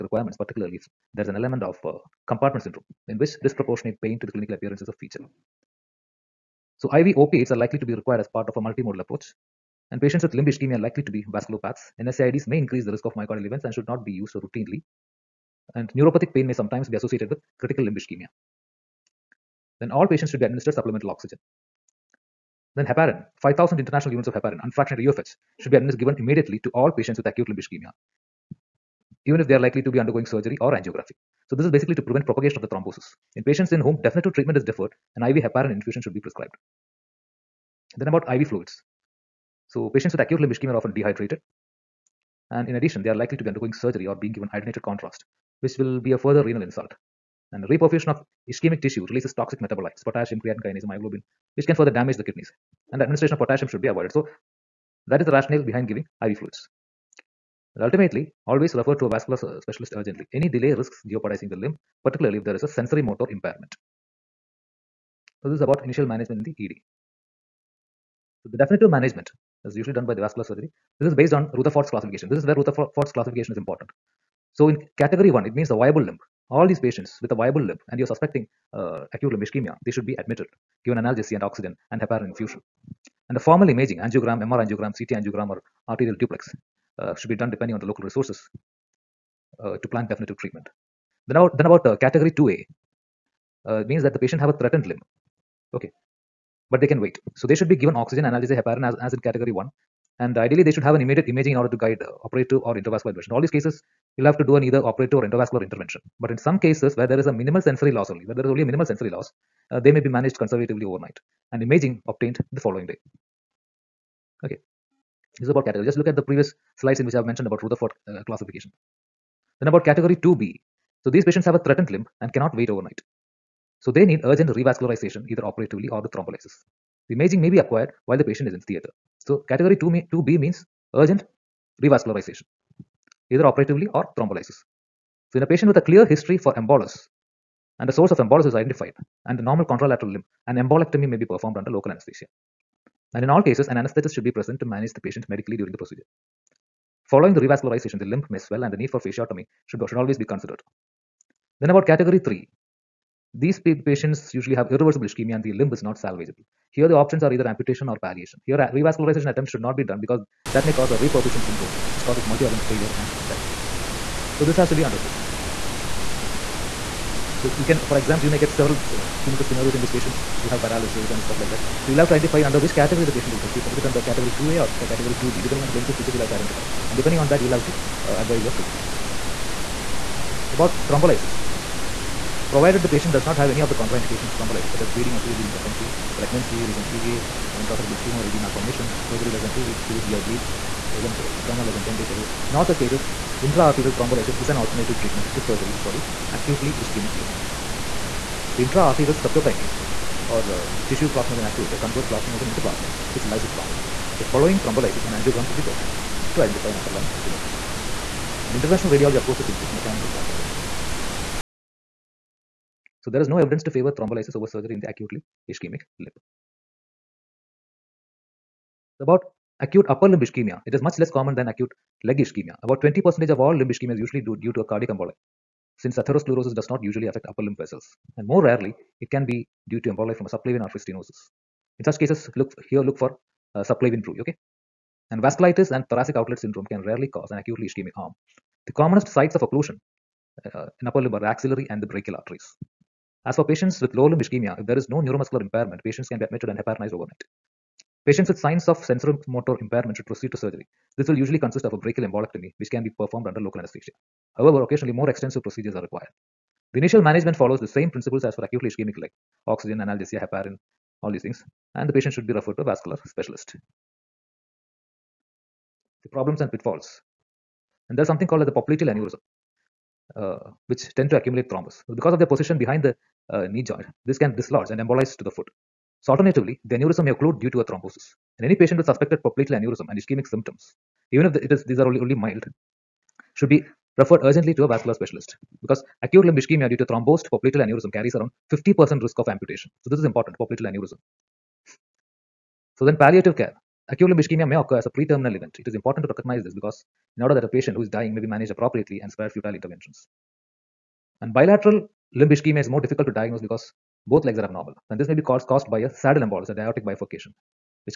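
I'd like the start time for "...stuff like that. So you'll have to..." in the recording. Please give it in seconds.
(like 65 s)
171 s.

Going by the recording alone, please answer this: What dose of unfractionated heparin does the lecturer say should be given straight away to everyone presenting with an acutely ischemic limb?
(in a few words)
5000 international units.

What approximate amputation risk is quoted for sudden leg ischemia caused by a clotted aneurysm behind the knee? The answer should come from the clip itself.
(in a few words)
50%.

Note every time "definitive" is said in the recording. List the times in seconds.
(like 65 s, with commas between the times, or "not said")
34 s, 68 s, 90 s.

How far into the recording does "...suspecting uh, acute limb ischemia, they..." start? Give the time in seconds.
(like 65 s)
78 s.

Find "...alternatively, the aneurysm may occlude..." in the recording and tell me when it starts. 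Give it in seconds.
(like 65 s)
276 s.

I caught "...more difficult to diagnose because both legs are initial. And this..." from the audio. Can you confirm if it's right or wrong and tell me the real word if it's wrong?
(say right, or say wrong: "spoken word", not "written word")
wrong: "abnormal", not "initial".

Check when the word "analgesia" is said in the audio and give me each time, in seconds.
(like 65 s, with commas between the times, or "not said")
80 s, 98 s, 259 s.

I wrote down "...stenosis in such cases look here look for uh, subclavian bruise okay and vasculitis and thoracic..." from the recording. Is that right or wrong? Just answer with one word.
right.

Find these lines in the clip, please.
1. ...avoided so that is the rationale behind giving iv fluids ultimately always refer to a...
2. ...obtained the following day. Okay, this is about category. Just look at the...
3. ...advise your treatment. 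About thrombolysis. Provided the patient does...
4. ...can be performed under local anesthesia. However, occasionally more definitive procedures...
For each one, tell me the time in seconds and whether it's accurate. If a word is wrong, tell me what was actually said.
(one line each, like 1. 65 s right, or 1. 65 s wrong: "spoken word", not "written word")
1. 53 s right
2. 112 s right
3. 178 s right
4. 252 s wrong: "extensive", not "definitive".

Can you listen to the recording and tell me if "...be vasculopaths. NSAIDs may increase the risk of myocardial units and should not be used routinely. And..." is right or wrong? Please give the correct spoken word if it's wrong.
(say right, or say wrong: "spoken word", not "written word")
wrong: "events", not "units".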